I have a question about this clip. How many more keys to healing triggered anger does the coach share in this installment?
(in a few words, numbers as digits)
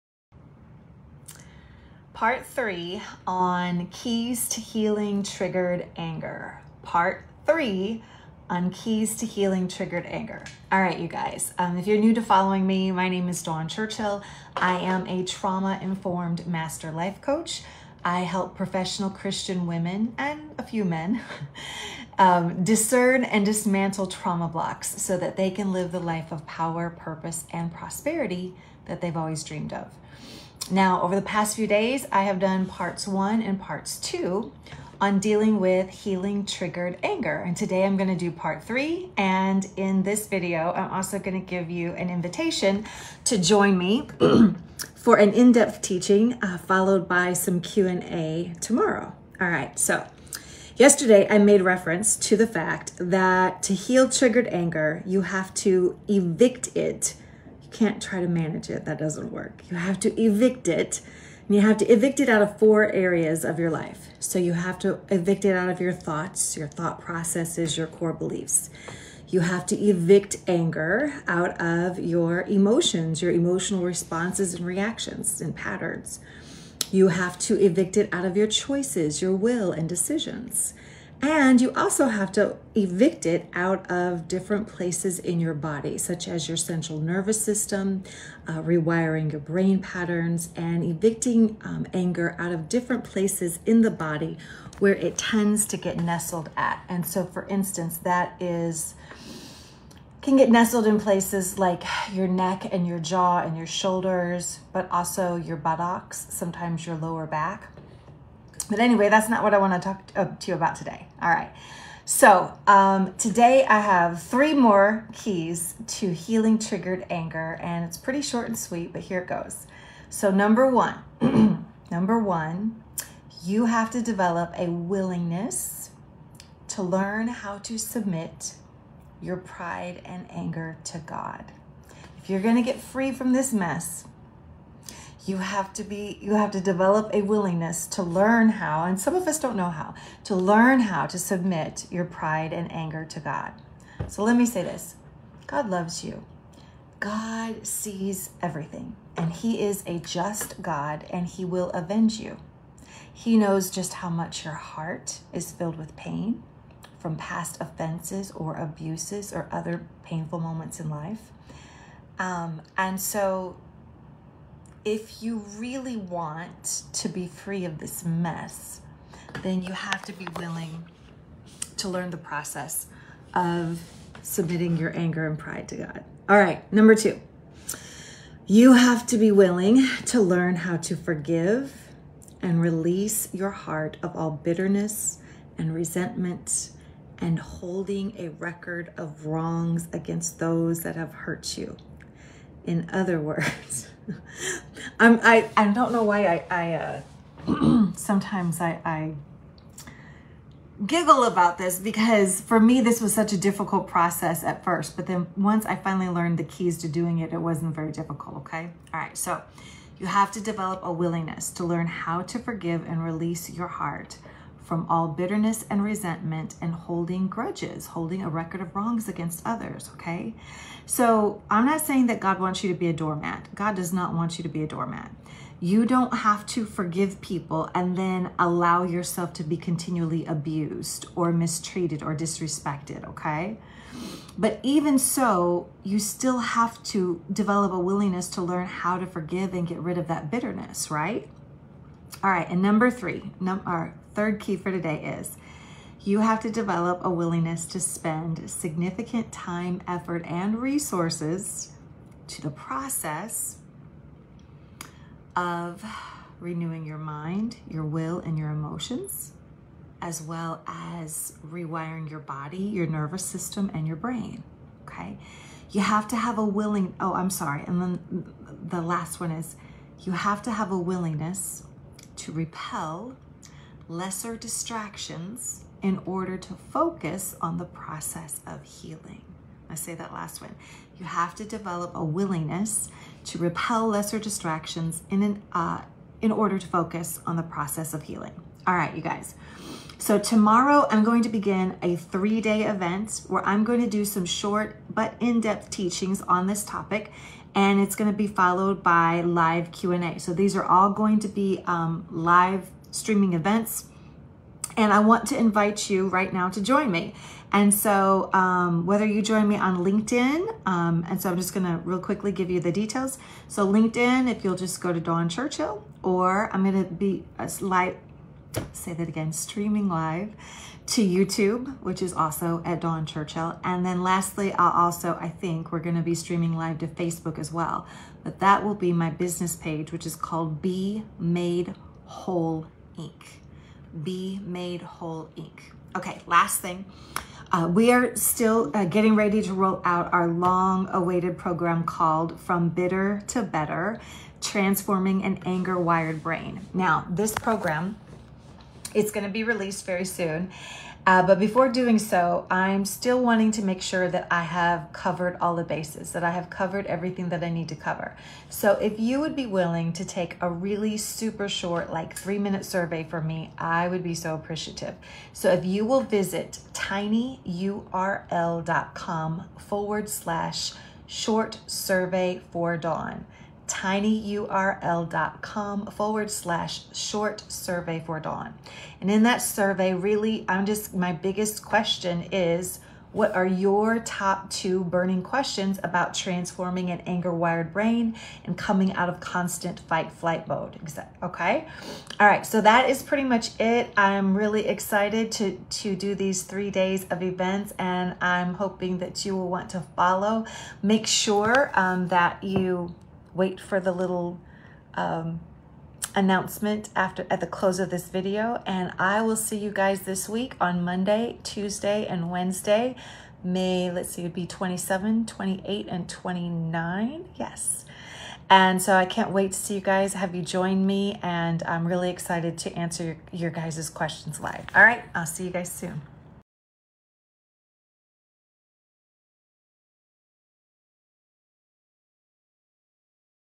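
3.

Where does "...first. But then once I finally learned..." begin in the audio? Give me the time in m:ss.
3:24.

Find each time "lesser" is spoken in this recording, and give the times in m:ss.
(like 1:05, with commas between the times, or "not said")
4:33, 4:43.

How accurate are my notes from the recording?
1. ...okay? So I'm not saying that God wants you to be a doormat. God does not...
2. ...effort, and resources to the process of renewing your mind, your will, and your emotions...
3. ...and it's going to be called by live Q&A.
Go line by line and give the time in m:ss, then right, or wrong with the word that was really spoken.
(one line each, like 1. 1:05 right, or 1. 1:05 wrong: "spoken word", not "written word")
1. 3:39 right
2. 4:09 right
3. 4:57 wrong: "followed", not "called".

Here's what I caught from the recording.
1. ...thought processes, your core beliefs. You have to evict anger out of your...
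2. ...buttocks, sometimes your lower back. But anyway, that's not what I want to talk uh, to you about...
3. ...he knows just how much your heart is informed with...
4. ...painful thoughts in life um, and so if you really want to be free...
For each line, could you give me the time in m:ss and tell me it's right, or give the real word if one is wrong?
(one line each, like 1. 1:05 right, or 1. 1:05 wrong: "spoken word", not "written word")
1. 1:06 right
2. 1:45 right
3. 2:33 wrong: "filled", not "informed"
4. 2:40 wrong: "moments", not "thoughts".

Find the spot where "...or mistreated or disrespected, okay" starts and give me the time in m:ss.
3:51.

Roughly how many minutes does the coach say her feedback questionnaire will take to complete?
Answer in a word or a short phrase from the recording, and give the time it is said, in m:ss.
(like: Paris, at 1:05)
3 minutes, at 6:02.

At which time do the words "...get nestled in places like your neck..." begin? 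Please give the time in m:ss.
1:40.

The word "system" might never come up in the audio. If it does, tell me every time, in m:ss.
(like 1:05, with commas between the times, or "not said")
1:27, 4:23.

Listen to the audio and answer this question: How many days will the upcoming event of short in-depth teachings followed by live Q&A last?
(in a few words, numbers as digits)
3.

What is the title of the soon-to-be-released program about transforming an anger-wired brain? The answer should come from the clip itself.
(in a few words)
From Bitter to Better.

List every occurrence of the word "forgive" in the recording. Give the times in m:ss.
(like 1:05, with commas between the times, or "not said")
3:00, 3:32, 3:46, 3:59.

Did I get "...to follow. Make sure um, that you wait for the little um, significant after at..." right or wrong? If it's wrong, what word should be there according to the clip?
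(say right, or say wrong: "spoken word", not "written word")
wrong: "announcement", not "significant".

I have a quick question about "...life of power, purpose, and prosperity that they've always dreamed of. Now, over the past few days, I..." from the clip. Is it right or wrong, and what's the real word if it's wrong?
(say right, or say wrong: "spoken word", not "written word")
right.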